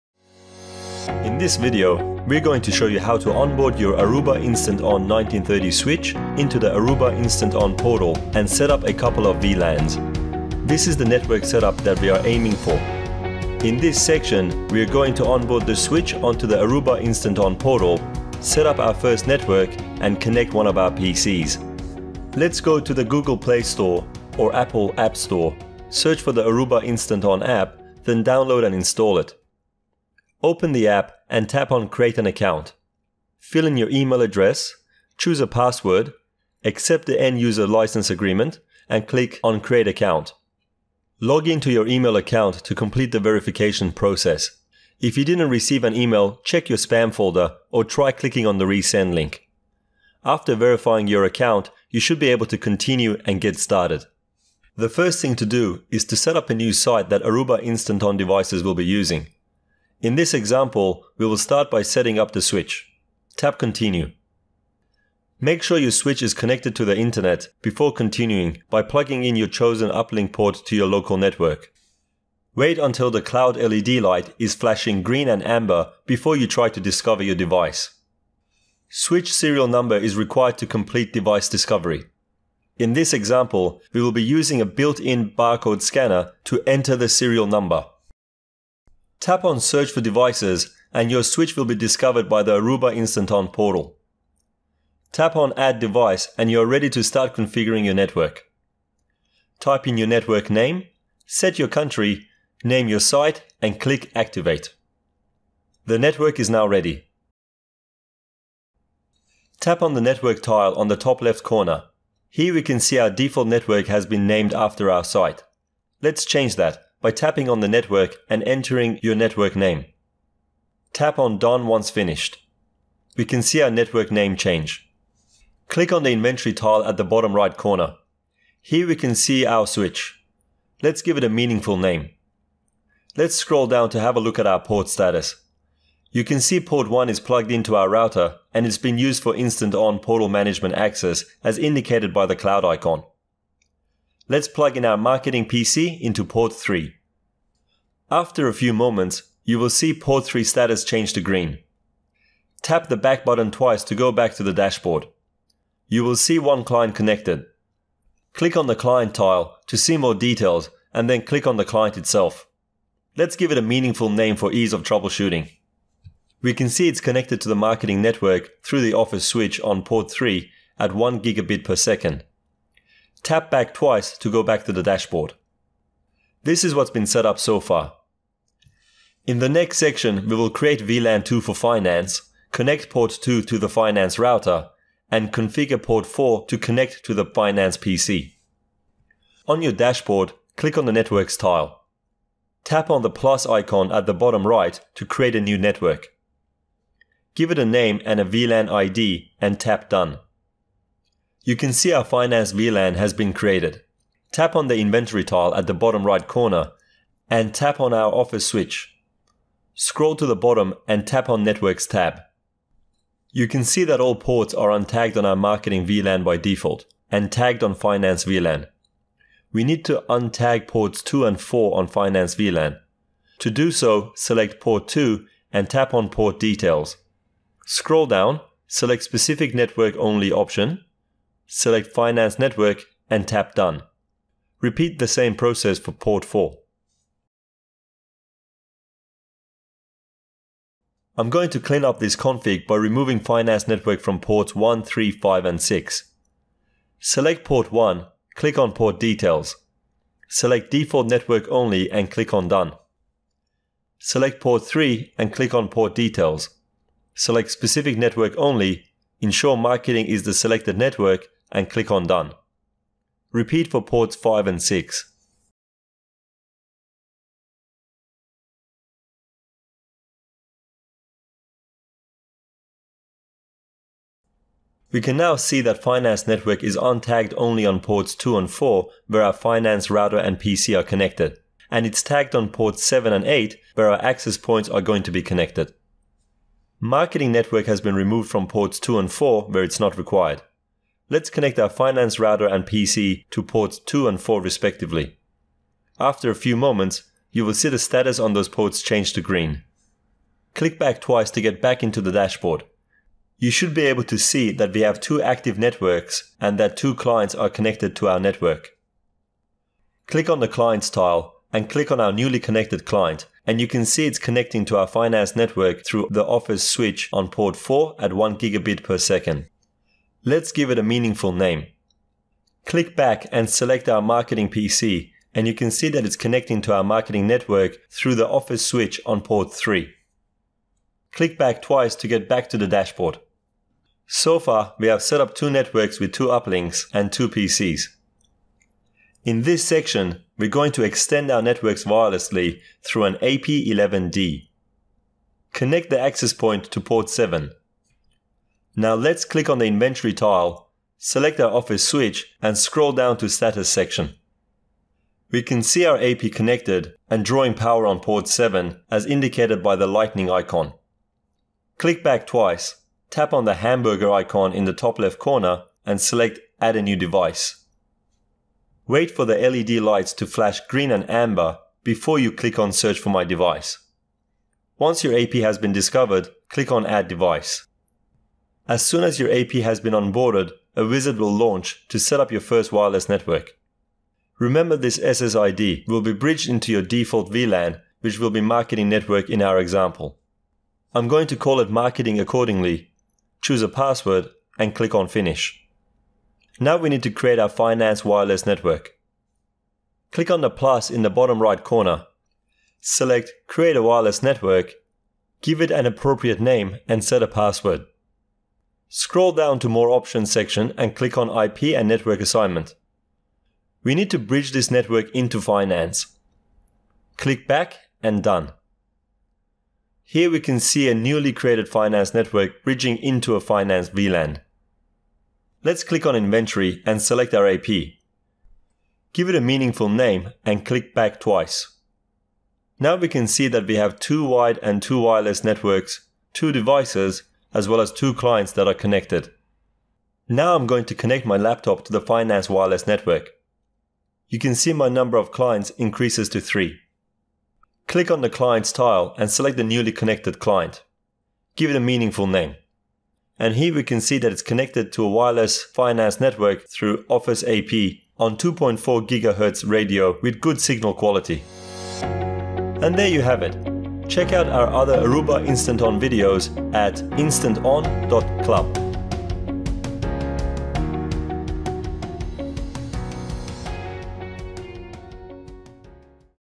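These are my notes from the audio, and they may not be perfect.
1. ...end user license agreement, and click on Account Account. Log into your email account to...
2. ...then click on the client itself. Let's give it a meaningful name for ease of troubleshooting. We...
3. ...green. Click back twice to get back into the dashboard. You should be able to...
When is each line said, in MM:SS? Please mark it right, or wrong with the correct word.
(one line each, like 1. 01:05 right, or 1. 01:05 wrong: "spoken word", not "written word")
1. 00:37 wrong: "Create", not "Account"
2. 02:41 right
3. 04:59 right.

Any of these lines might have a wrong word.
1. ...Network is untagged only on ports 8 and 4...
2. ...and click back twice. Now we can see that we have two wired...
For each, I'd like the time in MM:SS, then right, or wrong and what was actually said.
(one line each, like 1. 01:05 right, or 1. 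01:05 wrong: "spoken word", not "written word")
1. 04:36 wrong: "2", not "8"
2. 07:10 right.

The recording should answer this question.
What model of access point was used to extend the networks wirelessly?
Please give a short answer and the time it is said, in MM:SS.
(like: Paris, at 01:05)
AP11D, at 05:43.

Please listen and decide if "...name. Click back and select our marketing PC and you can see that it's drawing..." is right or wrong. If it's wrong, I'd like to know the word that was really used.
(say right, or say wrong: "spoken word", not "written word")
wrong: "connecting", not "drawing".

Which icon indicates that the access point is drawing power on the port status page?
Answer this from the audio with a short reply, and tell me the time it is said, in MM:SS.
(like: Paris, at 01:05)
lightning icon, at 05:59.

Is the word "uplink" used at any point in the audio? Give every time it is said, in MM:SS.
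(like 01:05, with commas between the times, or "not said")
01:09, 05:36.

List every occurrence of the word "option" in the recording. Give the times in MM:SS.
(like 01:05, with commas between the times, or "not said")
03:50, 06:49.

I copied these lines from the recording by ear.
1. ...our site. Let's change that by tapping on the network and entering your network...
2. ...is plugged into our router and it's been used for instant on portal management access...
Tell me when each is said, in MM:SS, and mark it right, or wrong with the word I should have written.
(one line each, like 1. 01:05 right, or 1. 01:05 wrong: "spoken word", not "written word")
1. 01:54 right
2. 02:17 right.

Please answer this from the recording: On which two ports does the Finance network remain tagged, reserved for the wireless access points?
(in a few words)
7 and 8.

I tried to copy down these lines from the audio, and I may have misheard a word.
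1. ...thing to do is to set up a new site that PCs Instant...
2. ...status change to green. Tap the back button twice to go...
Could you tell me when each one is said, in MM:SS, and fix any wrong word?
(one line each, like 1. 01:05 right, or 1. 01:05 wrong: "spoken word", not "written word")
1. 00:55 wrong: "Aruba", not "PCs"
2. 02:30 right.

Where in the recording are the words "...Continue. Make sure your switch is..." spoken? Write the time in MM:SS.
01:03.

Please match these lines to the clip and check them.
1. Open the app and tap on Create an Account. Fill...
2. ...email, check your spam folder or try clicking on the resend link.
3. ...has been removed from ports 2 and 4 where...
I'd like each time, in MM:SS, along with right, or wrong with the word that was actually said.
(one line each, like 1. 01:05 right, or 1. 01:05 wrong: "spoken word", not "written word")
1. 00:30 right
2. 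00:45 right
3. 04:47 right.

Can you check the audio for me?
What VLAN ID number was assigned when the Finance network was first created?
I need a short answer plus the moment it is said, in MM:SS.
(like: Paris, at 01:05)
2, at 03:00.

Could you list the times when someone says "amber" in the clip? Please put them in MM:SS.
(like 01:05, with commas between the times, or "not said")
01:15, 06:11.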